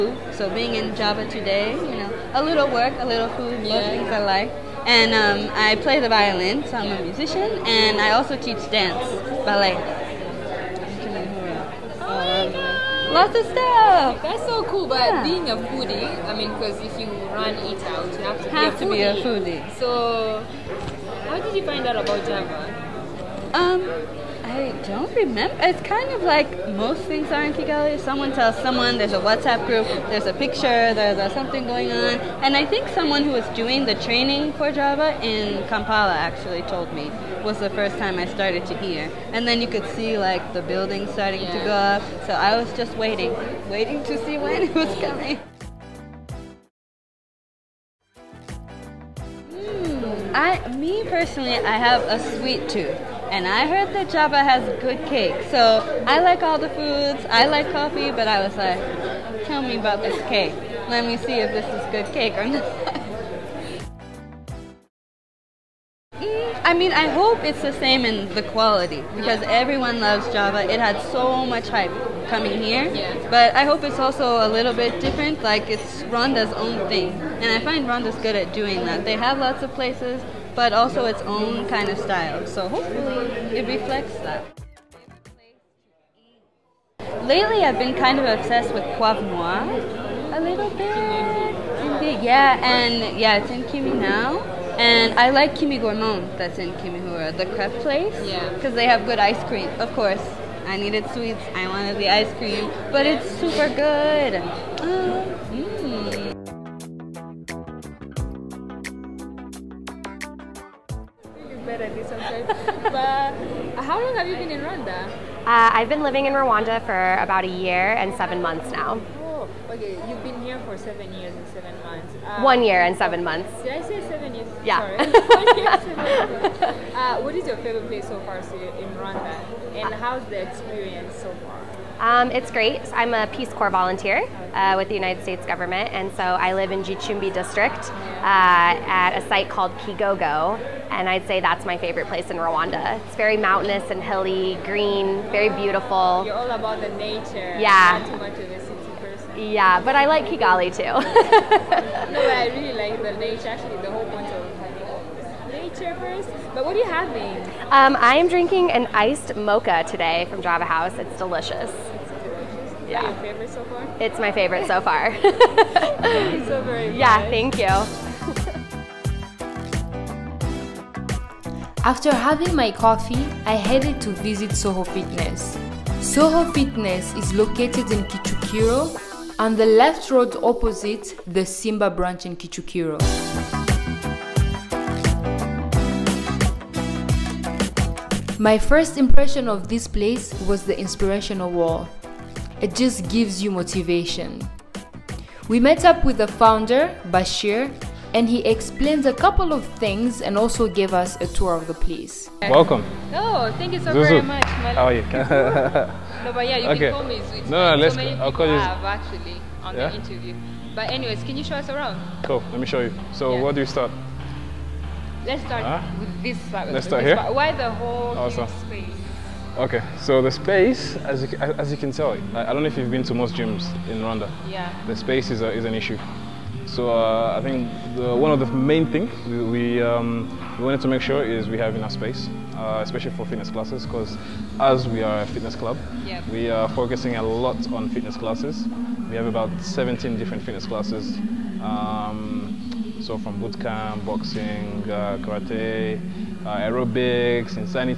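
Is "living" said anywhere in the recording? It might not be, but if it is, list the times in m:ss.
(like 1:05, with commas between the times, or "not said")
1:56.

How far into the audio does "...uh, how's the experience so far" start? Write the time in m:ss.
2:09.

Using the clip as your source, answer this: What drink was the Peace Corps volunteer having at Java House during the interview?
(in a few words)
Iced mocha.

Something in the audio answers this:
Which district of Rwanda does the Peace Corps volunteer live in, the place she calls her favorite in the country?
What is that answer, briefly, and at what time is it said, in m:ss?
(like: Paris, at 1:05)
Gicumbi, at 2:16.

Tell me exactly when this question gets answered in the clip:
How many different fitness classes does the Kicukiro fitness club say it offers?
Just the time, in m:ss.
3:59.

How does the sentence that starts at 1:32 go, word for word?
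Yeah, and yeah, it's in Kimi now.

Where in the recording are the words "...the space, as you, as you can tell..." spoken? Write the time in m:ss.
3:40.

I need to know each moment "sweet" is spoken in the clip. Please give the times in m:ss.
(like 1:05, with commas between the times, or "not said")
0:52, 1:41.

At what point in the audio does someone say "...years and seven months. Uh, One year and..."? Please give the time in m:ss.
2:01.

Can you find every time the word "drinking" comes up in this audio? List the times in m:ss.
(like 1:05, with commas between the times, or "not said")
2:38.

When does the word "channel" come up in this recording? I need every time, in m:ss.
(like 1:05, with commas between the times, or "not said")
not said.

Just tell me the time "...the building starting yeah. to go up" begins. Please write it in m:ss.
0:40.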